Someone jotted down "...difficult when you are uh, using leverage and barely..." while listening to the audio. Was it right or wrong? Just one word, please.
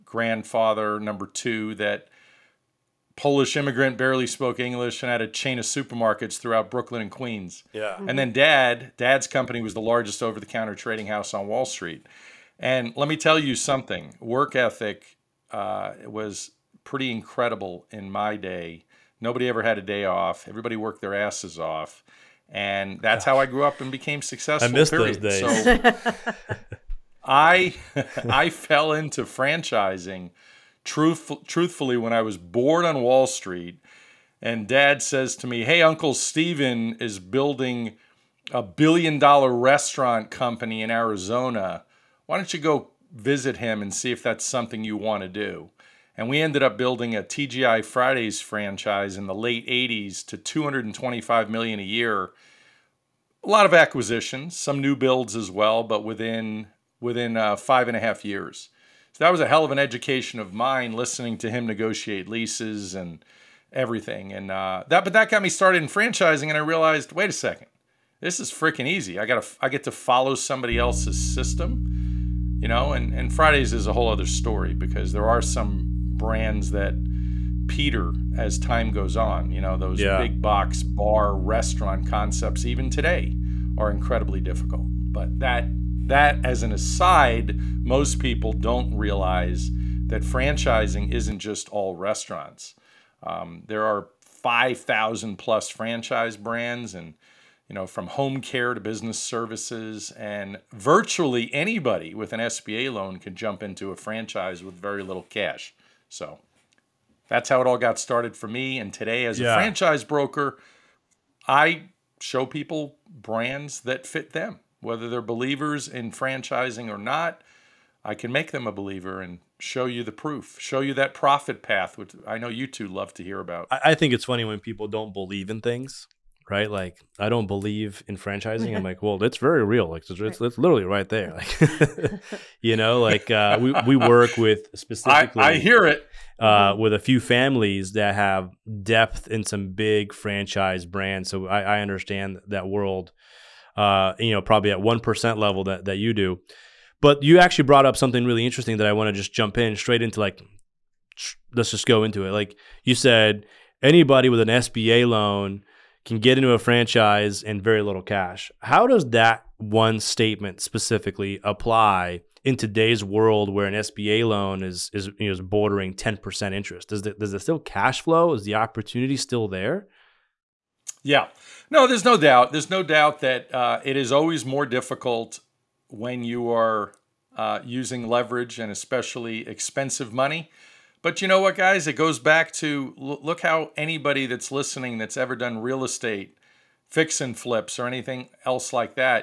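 wrong.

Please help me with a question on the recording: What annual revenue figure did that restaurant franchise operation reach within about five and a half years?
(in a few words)
225 million.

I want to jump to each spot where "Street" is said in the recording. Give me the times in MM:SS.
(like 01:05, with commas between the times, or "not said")
00:11, 00:33.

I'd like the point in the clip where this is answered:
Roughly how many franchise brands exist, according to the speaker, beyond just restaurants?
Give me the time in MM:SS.
01:34.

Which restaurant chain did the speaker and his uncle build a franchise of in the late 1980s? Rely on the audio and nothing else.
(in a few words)
TGI Fridays.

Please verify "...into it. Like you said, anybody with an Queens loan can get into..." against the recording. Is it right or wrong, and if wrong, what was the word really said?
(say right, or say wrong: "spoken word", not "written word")
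wrong: "SBA", not "Queens".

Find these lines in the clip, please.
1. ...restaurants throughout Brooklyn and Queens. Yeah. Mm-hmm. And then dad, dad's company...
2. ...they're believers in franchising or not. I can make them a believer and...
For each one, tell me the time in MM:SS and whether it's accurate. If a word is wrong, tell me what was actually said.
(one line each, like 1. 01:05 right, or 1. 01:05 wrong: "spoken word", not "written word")
1. 00:05 wrong: "supermarkets", not "restaurants"
2. 01:55 right.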